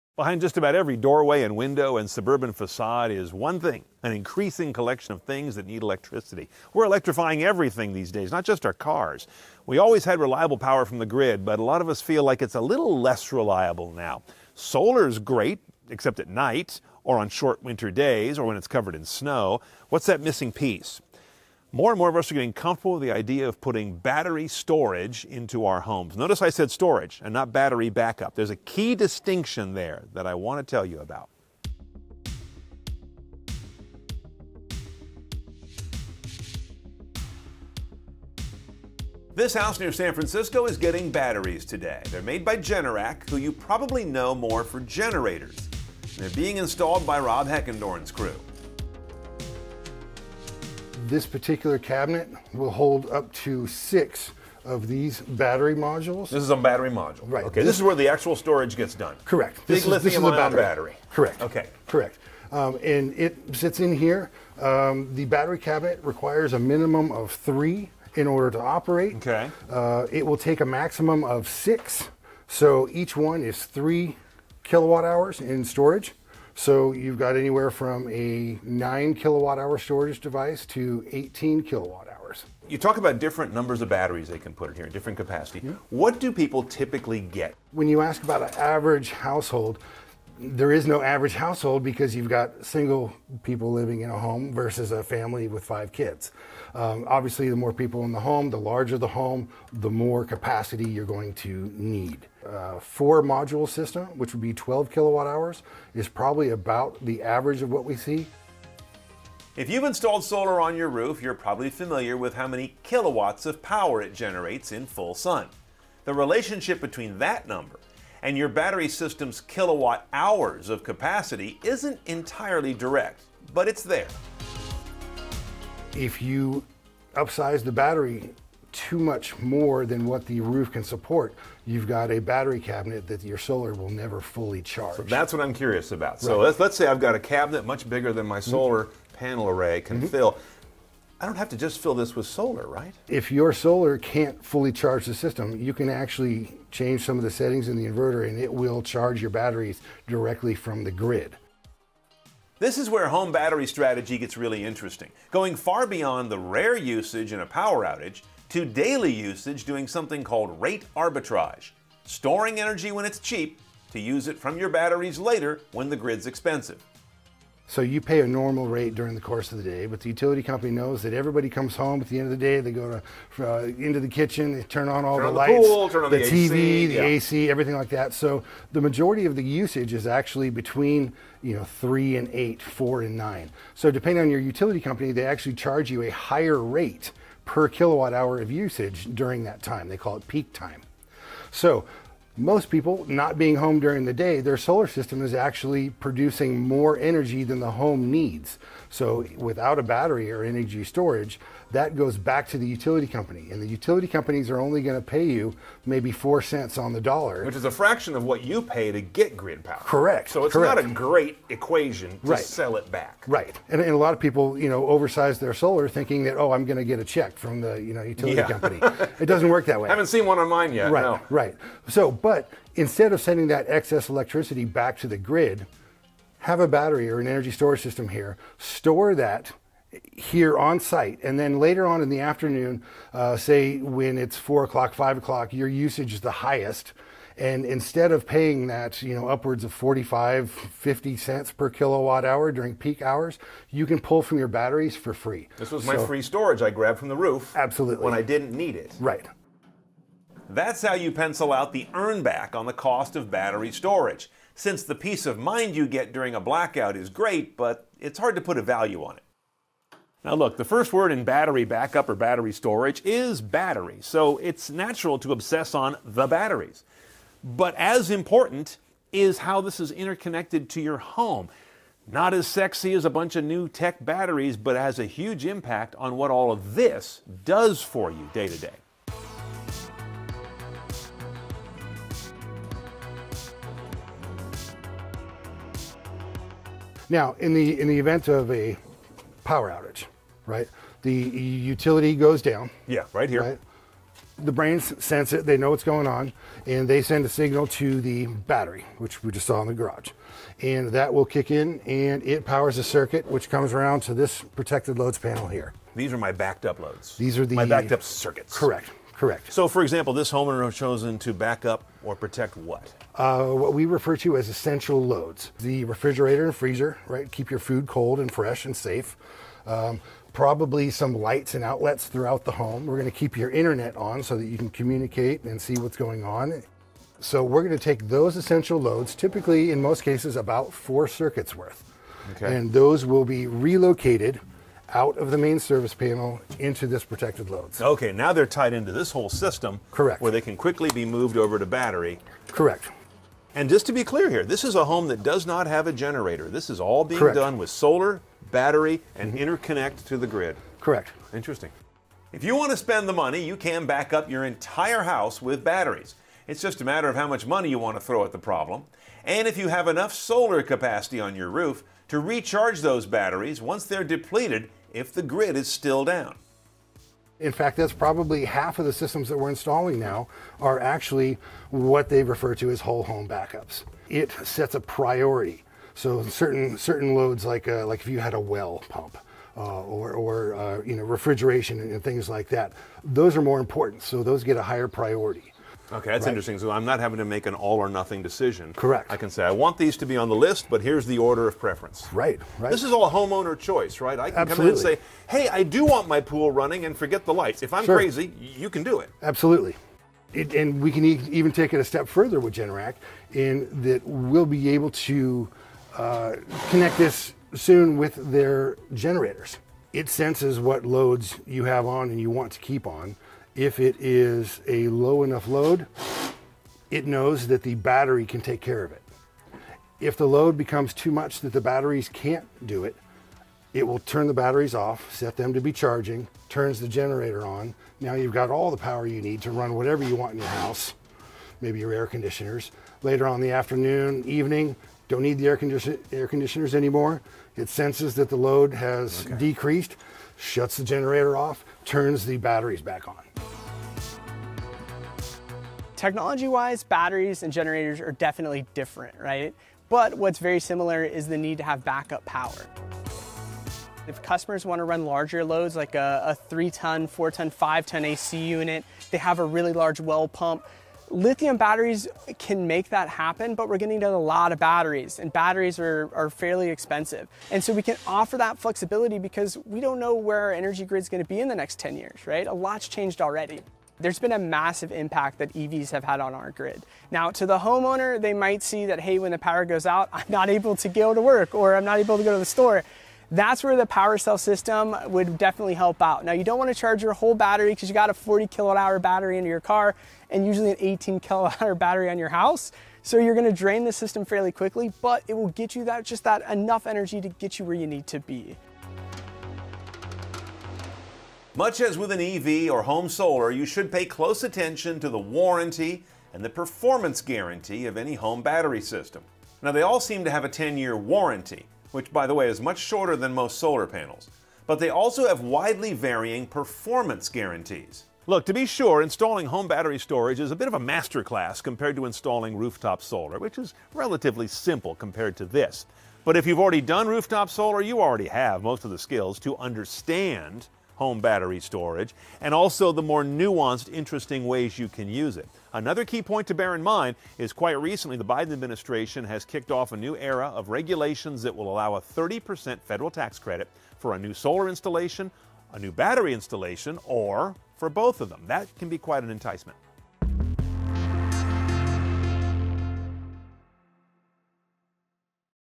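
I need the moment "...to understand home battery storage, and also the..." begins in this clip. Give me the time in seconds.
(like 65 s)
529 s.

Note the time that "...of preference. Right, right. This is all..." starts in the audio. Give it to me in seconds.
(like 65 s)
391 s.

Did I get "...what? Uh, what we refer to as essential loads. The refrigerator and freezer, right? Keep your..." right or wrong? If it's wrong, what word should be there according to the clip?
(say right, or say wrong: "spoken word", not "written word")
right.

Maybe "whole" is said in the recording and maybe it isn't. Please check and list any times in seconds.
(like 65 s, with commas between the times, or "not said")
339 s, 372 s, 487 s.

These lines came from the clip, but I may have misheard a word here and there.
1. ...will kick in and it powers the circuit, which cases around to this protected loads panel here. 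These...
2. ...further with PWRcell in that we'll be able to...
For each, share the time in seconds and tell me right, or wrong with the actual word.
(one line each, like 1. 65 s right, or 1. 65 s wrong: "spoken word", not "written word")
1. 301 s wrong: "comes", not "cases"
2. 402 s wrong: "Generac", not "PWRcell".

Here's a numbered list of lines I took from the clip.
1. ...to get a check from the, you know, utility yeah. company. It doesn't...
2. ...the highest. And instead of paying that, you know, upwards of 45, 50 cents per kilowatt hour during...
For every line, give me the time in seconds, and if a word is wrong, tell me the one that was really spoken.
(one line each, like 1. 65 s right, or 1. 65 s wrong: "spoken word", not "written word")
1. 216 s right
2. 236 s right.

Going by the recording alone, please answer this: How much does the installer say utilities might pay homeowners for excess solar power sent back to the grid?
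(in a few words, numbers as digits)
4 cents on the dollar.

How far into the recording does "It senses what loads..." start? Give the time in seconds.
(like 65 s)
409 s.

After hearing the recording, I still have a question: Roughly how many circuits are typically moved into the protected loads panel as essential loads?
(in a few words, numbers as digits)
4.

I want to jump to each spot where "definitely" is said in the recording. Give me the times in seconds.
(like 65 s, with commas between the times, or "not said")
448 s, 485 s.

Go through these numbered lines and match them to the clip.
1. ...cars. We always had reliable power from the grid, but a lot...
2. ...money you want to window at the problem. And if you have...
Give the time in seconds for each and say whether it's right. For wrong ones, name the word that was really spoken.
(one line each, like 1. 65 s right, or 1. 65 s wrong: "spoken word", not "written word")
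1. 8 s right
2. 357 s wrong: "throw", not "window".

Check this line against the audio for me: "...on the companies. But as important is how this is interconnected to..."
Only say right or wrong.
wrong.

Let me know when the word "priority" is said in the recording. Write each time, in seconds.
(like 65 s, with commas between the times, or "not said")
374 s, 384 s.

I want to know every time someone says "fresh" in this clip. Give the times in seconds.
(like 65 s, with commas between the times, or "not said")
318 s.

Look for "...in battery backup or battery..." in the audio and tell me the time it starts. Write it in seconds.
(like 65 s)
261 s.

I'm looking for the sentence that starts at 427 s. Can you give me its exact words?
Now you've got all the power you need to run whatever you want in your house, maybe your air conditioners.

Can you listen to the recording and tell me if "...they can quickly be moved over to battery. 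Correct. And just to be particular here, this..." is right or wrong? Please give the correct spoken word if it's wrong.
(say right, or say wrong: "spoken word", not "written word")
wrong: "clear", not "particular".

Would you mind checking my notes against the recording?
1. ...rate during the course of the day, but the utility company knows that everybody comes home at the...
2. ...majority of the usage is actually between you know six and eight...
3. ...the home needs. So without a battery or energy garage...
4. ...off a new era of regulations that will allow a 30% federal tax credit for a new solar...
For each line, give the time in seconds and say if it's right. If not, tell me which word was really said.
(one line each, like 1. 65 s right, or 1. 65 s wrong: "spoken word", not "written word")
1. 168 s right
2. 178 s wrong: "three", not "six"
3. 197 s wrong: "storage", not "garage"
4. 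539 s right.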